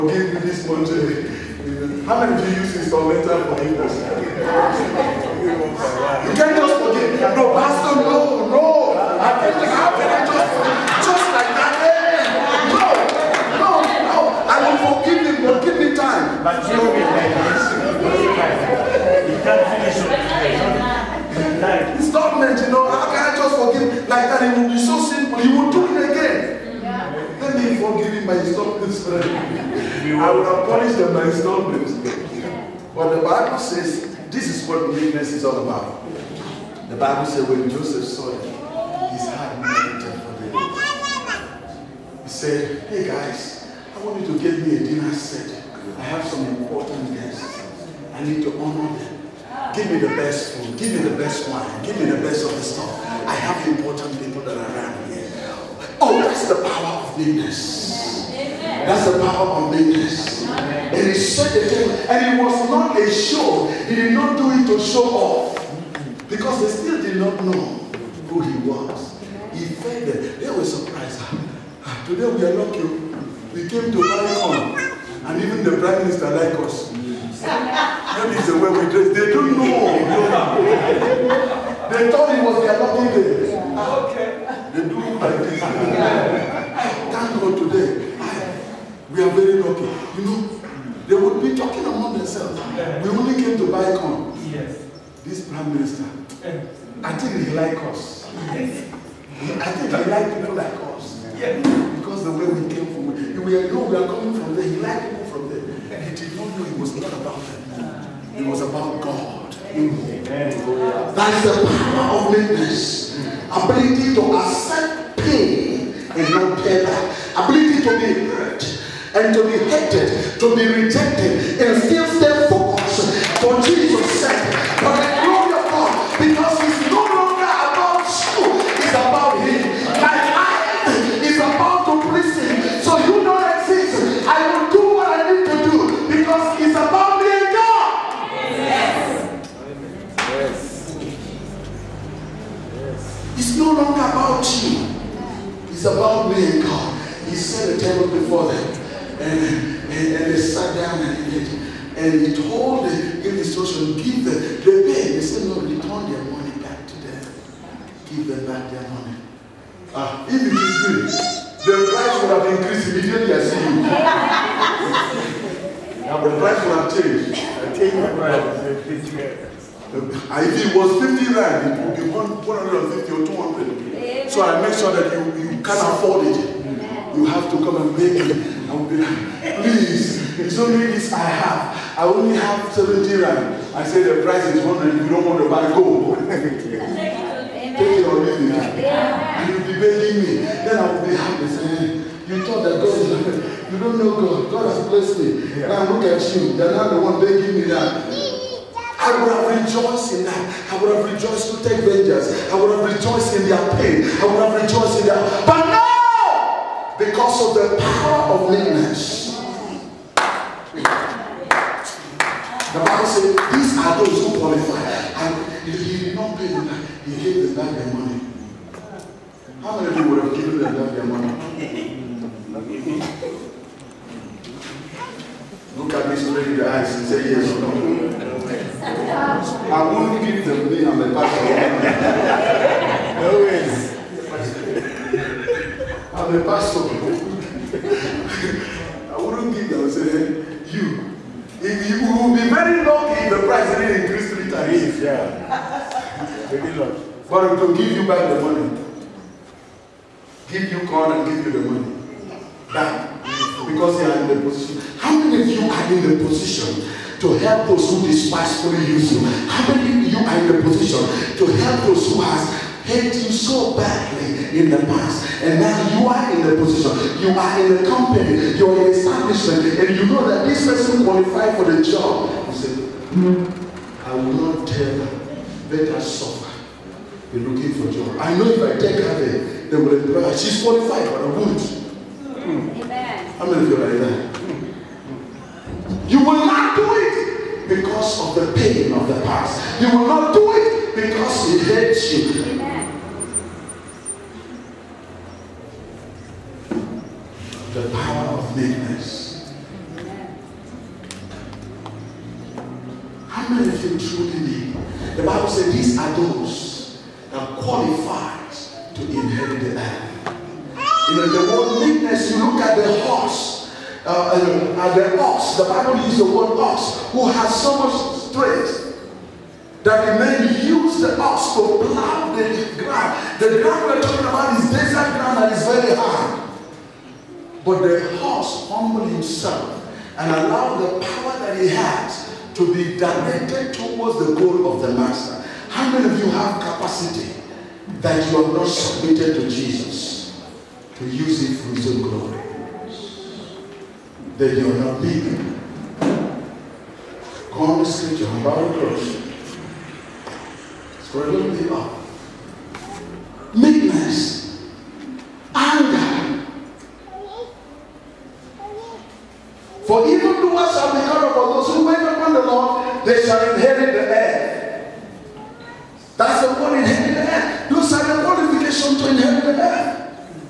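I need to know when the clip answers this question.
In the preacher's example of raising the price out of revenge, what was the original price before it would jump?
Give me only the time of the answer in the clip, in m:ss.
2:51.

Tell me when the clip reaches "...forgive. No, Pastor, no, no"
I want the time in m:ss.
0:06.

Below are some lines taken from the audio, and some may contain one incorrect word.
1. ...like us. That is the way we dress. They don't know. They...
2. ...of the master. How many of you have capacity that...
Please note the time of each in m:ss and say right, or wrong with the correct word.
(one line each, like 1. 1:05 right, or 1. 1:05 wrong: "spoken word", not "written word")
1. 1:16 right
2. 5:34 right.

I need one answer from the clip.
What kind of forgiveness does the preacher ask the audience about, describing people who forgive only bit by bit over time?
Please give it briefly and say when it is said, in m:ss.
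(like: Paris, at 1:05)
instrumental forgiveness, at 0:02.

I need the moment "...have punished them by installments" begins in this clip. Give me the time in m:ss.
0:30.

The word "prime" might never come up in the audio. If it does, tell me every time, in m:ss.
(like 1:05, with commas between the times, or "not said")
1:15, 1:35.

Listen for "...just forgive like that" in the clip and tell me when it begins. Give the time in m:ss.
0:23.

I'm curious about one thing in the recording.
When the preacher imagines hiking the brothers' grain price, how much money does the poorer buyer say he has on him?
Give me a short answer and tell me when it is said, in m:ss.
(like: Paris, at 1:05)
70 rand, at 3:02.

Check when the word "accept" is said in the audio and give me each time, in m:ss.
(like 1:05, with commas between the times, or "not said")
1:54.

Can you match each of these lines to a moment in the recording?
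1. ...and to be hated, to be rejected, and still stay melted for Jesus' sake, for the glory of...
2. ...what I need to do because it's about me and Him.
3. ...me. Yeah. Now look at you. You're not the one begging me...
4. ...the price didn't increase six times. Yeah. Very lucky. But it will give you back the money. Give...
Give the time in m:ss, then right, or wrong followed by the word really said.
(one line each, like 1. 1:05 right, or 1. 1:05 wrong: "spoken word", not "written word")
1. 1:59 wrong: "focused", not "melted"
2. 2:14 wrong: "God", not "Him"
3. 3:15 right
4. 4:03 wrong: "three", not "six".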